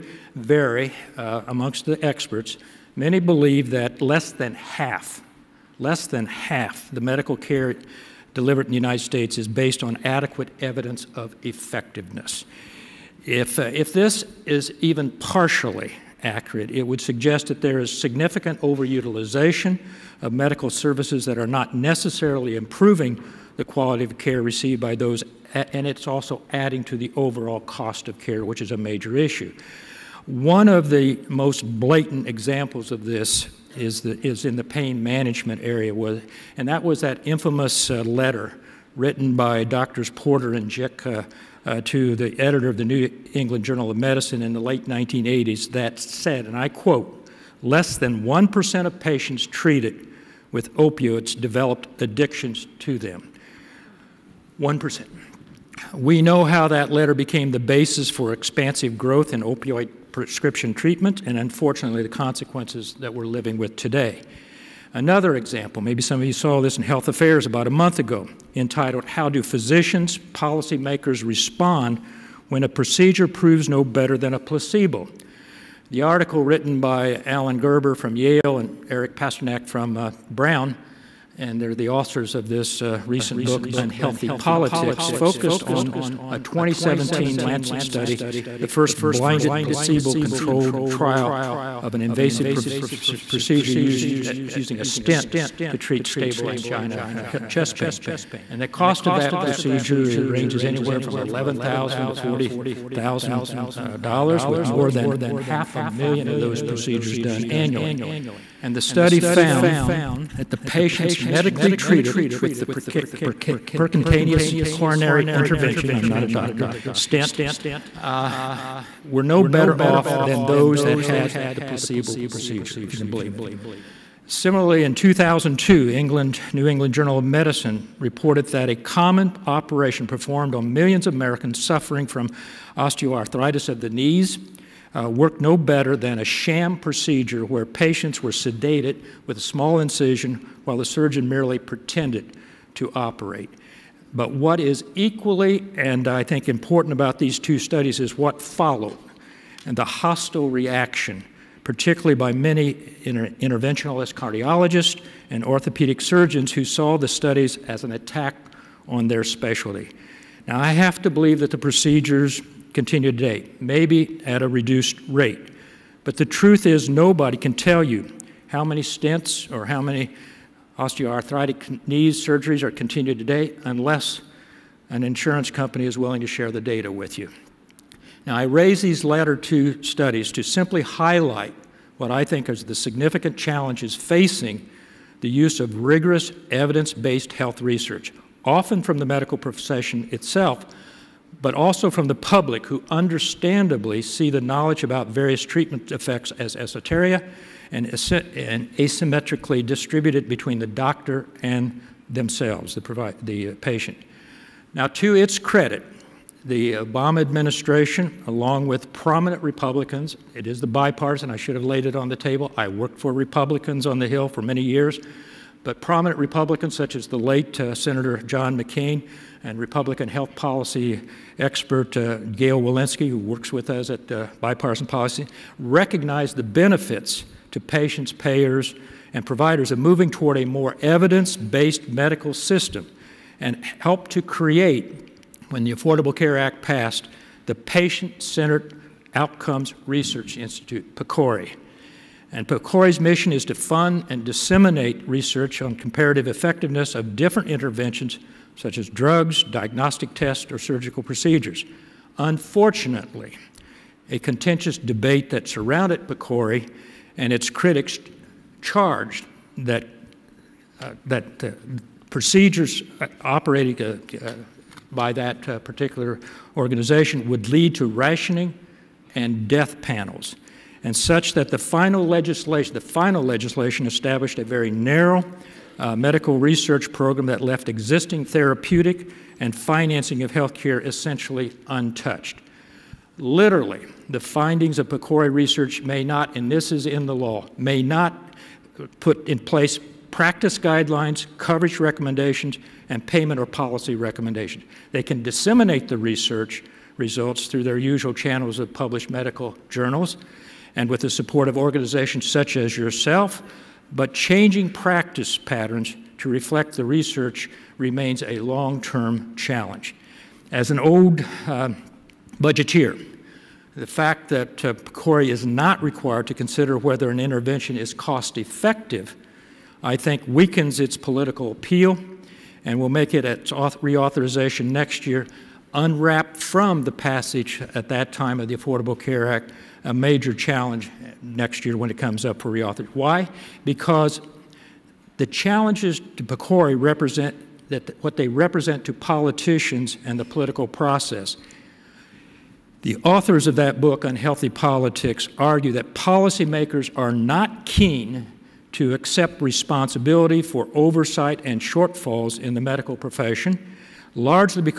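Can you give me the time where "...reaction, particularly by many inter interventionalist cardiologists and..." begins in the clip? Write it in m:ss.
2:30.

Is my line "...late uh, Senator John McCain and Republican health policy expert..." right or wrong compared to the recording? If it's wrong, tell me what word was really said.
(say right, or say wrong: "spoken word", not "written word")
right.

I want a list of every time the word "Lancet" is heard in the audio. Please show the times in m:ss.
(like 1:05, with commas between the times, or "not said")
1:27.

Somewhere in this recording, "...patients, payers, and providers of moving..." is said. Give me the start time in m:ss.
3:47.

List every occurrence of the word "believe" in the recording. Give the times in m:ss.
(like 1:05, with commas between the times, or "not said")
0:03, 2:03, 2:41.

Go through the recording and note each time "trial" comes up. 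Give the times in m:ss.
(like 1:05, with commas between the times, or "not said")
1:30.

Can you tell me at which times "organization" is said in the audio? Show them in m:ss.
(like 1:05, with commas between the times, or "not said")
4:26, 5:01.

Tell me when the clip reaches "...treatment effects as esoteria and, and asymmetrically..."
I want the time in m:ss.
3:15.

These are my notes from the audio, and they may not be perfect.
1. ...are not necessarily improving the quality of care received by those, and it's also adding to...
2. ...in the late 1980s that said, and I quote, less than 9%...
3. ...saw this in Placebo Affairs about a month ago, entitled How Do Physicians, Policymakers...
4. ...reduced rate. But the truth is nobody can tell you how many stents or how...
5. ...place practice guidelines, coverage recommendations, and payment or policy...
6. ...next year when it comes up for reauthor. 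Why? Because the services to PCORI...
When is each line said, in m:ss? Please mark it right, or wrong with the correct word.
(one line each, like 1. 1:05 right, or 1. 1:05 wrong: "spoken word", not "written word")
1. 0:21 right
2. 0:44 wrong: "1", not "9"
3. 1:06 wrong: "Health", not "Placebo"
4. 2:44 right
5. 4:49 right
6. 5:31 wrong: "challenges", not "services".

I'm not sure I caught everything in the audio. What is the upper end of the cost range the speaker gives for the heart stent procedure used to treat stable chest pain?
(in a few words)
$40,000.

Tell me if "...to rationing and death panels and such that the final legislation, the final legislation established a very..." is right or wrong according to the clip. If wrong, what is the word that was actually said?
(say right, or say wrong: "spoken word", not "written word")
right.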